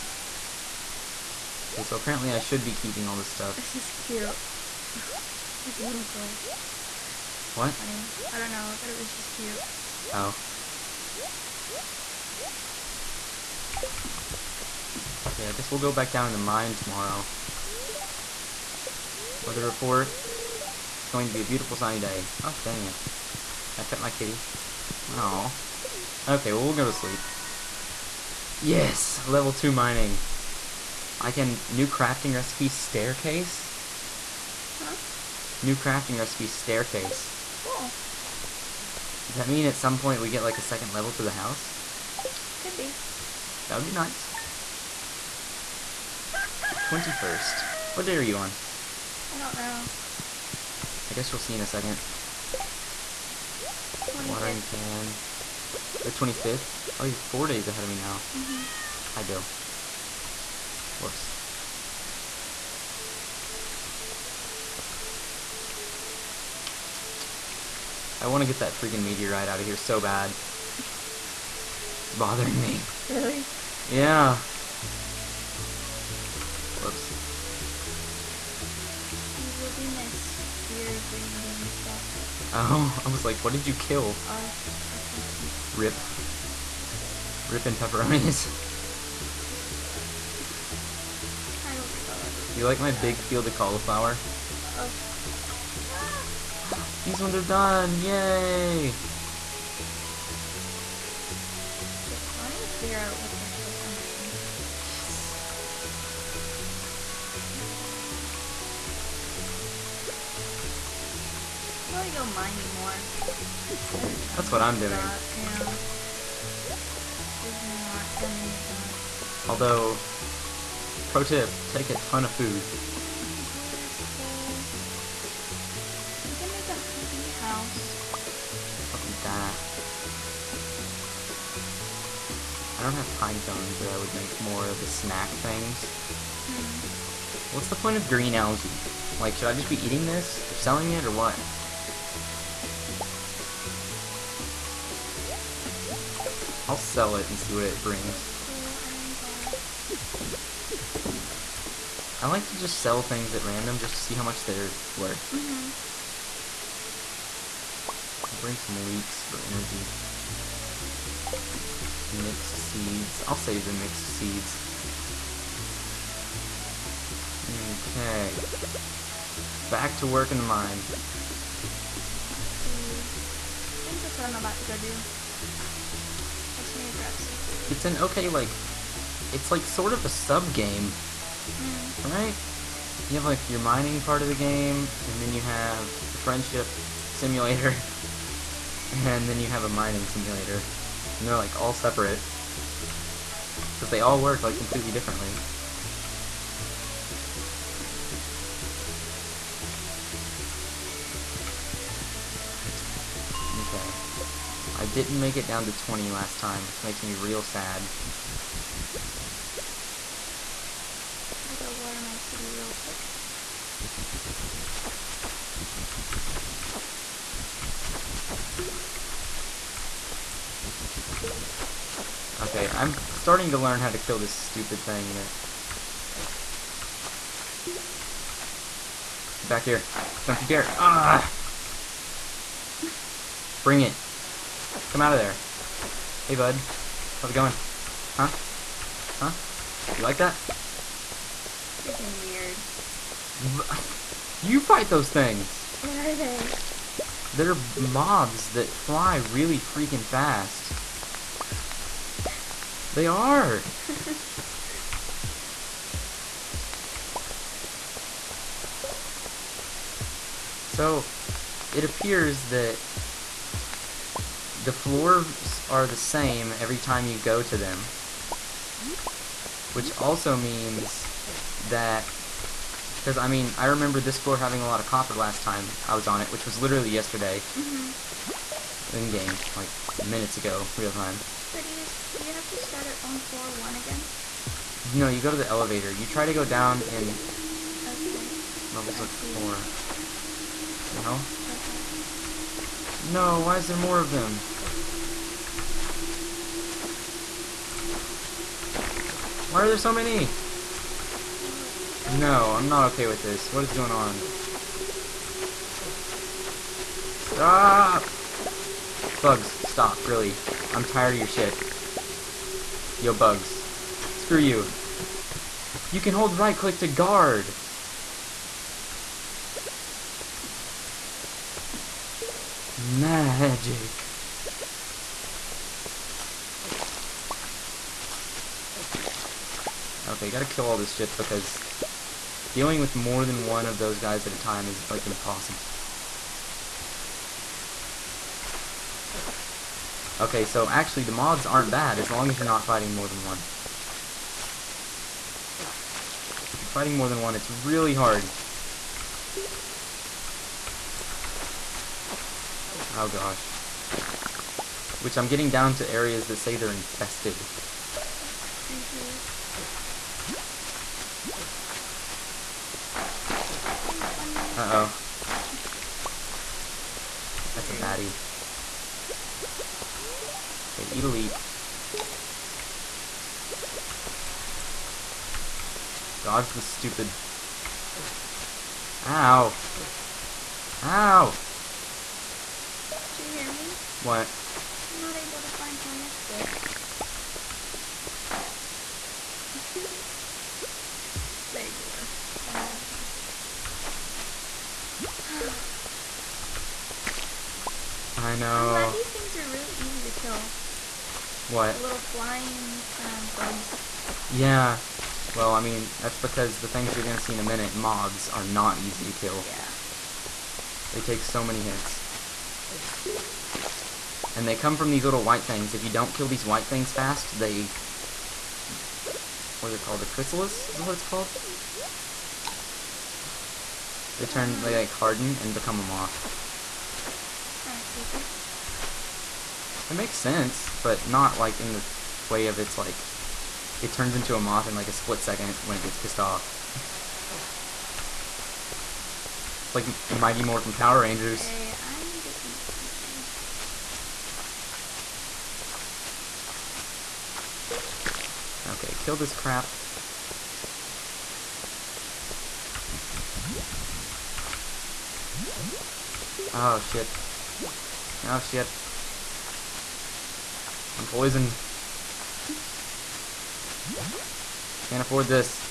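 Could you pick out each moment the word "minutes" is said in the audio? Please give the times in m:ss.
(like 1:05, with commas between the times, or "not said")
4:40, 6:47.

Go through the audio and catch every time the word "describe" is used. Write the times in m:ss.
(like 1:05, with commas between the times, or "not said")
not said.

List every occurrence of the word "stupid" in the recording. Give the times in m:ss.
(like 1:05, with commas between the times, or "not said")
3:44, 6:16.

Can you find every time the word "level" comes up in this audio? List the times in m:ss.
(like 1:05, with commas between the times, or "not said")
0:29, 0:40, 4:48.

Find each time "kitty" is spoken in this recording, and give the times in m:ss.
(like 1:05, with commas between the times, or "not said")
0:24, 3:32.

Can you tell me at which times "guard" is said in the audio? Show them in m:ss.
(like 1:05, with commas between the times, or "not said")
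5:16.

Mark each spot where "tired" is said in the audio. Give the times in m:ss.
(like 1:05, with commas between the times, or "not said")
5:10.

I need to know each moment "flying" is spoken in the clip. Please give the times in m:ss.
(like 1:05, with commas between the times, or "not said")
6:41.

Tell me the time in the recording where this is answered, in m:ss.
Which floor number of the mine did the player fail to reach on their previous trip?
3:25.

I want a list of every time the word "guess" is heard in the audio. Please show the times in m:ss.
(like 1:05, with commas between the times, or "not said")
0:15, 0:51.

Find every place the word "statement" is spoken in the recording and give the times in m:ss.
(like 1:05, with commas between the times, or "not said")
not said.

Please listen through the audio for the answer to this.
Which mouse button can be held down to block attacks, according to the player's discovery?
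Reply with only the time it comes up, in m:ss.
5:16.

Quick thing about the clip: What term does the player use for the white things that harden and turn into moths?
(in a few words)
Chrysalis.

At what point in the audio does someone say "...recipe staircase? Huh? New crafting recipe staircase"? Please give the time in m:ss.
0:32.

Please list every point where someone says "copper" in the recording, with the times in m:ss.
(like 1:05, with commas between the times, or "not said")
4:34.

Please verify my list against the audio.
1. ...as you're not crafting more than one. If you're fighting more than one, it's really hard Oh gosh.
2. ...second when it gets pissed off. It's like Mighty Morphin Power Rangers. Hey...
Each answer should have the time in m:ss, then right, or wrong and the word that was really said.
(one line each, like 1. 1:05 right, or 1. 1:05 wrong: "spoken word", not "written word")
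1. 5:42 wrong: "fighting", not "crafting"
2. 7:15 right.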